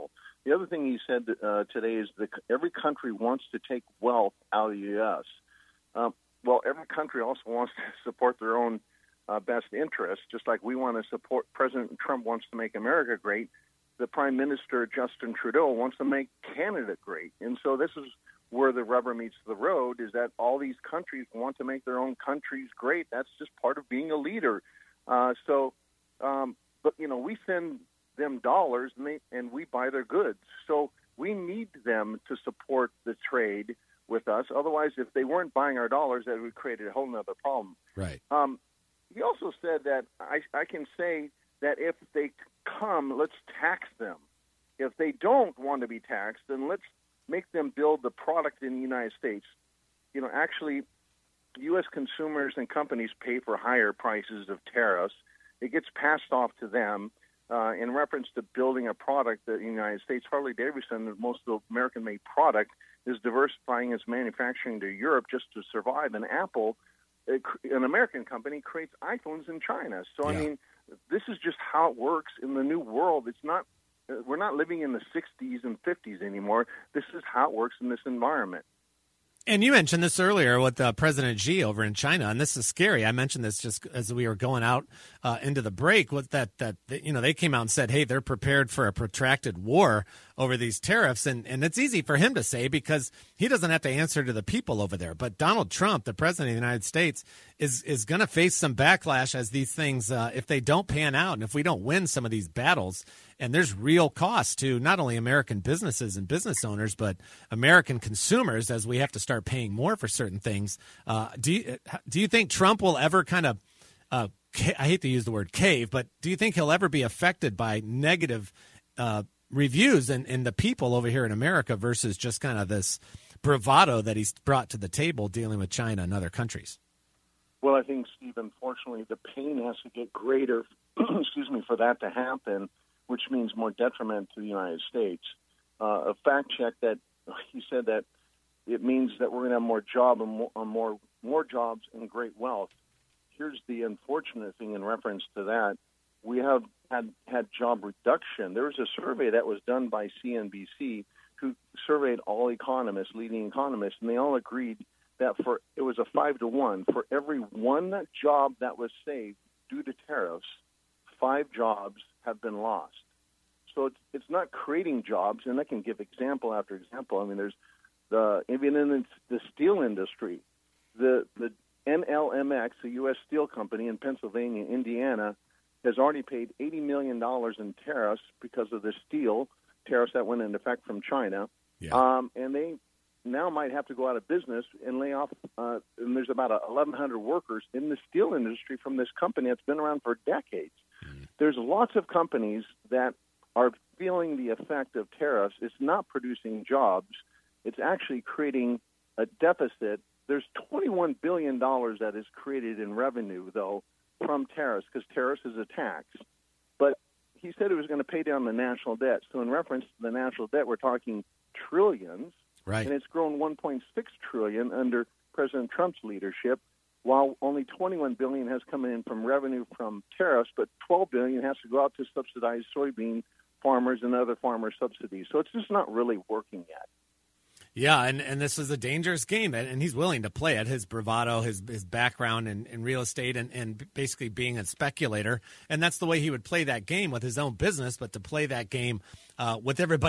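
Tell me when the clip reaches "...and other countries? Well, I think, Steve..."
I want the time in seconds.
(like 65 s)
126 s.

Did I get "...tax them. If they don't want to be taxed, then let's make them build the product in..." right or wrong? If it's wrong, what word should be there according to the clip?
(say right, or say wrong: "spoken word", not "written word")
right.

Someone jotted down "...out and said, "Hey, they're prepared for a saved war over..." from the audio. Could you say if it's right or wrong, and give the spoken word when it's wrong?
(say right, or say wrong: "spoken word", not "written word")
wrong: "protracted", not "saved".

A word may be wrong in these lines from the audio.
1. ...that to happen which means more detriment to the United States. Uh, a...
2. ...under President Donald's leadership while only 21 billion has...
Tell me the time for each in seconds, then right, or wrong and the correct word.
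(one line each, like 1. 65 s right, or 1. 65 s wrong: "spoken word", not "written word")
1. 131 s right
2. 214 s wrong: "Trump", not "Donald".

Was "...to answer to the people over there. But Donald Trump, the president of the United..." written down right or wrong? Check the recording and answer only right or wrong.
right.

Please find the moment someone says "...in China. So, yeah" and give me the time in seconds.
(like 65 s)
69 s.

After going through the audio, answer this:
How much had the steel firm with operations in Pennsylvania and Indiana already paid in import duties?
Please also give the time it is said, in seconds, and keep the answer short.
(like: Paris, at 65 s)
$80 million, at 176 s.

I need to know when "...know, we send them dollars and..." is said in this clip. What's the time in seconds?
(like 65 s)
27 s.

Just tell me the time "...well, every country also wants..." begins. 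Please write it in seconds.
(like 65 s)
6 s.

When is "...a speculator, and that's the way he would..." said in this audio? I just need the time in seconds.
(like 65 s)
234 s.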